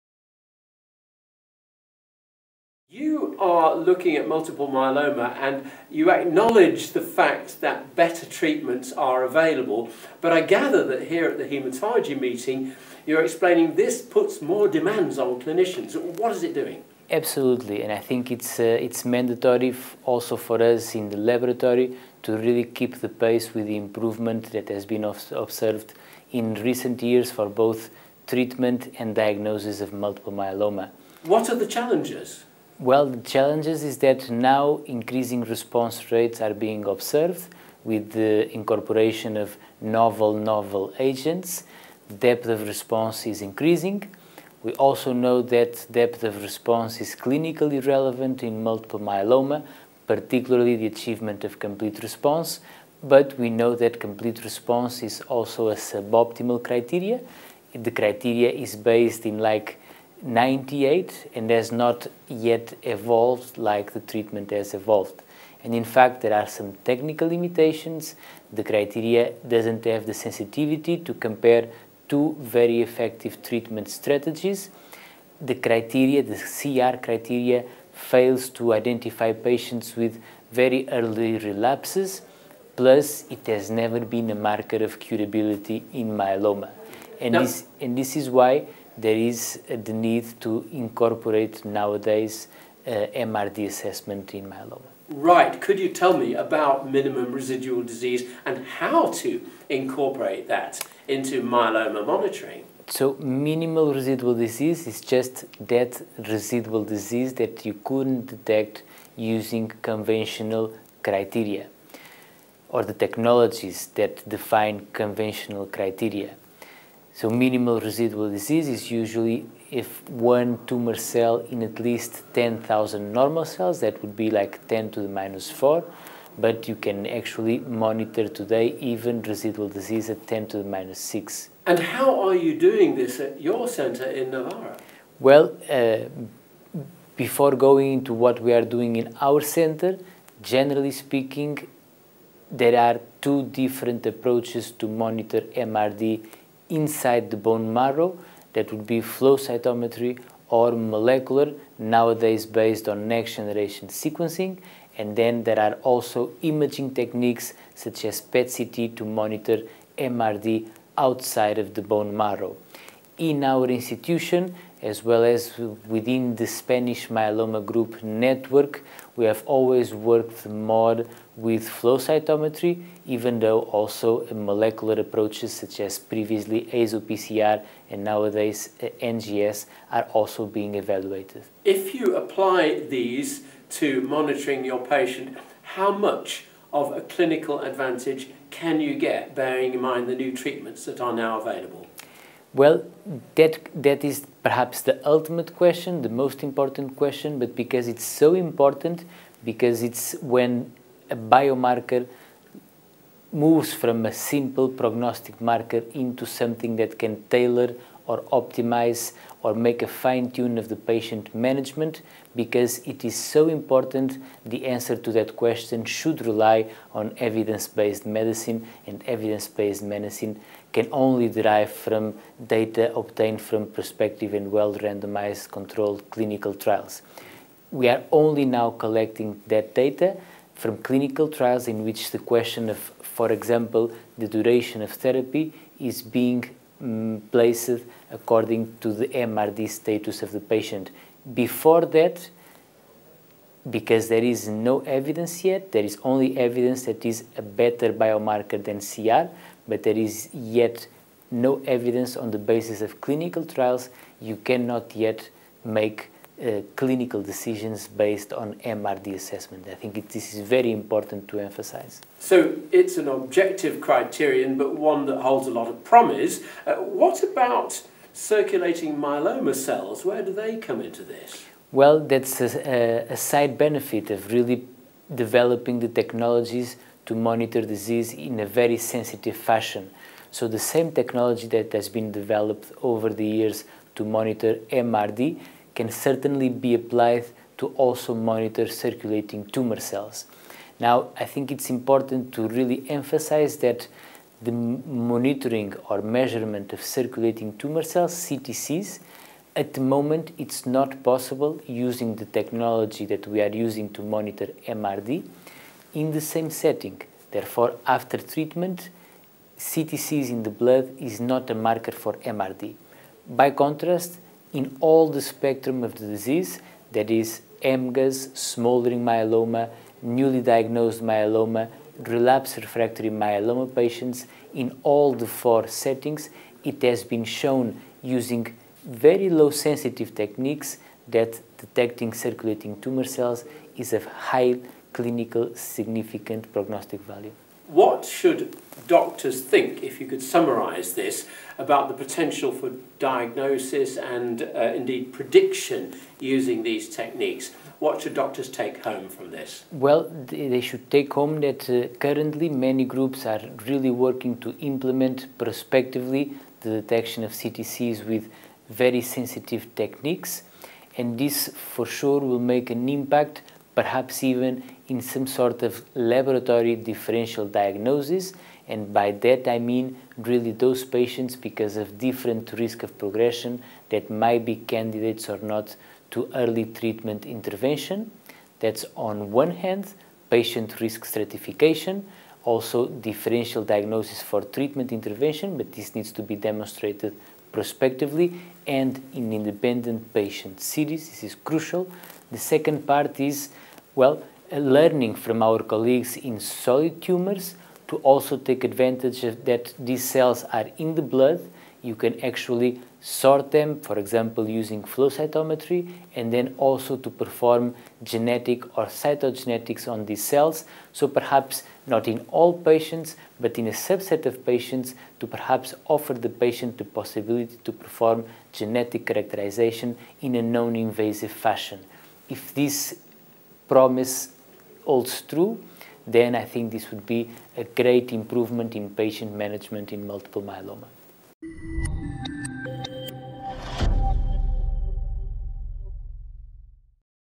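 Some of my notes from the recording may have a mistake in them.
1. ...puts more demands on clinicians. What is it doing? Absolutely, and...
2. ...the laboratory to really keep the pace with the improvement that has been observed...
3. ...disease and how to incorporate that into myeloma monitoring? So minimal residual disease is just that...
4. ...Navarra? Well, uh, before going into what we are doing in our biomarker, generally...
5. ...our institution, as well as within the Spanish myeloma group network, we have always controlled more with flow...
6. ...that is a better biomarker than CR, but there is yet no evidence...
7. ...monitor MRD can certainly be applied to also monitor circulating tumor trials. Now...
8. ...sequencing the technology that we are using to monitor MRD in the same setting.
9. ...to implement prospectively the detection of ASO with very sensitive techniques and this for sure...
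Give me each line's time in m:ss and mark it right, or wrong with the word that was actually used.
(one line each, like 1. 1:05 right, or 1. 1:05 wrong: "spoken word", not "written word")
1. 0:14 right
2. 0:21 right
3. 1:37 right
4. 2:14 wrong: "center", not "biomarker"
5. 2:43 wrong: "worked", not "controlled"
6. 4:06 right
7. 4:44 wrong: "cells", not "trials"
8. 5:01 wrong: "using", not "sequencing"
9. 5:54 wrong: "CTCs", not "ASO".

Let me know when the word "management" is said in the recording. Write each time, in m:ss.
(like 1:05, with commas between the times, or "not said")
3:31, 7:09.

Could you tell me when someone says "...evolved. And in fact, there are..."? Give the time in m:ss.
1:04.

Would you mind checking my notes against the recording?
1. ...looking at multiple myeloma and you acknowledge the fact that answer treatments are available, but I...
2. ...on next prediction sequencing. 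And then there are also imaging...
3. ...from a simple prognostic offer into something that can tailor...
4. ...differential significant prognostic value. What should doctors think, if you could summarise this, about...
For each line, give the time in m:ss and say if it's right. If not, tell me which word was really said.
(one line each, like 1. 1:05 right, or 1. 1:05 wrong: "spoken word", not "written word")
1. 0:03 wrong: "better", not "answer"
2. 2:32 wrong: "generation", not "prediction"
3. 3:23 wrong: "marker", not "offer"
4. 5:34 wrong: "clinical", not "differential".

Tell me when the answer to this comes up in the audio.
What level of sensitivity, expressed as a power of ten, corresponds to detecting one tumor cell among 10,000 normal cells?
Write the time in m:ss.
2:04.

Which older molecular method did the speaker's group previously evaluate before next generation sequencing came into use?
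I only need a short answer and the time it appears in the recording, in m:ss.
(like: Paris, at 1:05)
ASO PCR, at 2:56.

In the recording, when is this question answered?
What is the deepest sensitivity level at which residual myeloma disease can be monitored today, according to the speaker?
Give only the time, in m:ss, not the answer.
2:10.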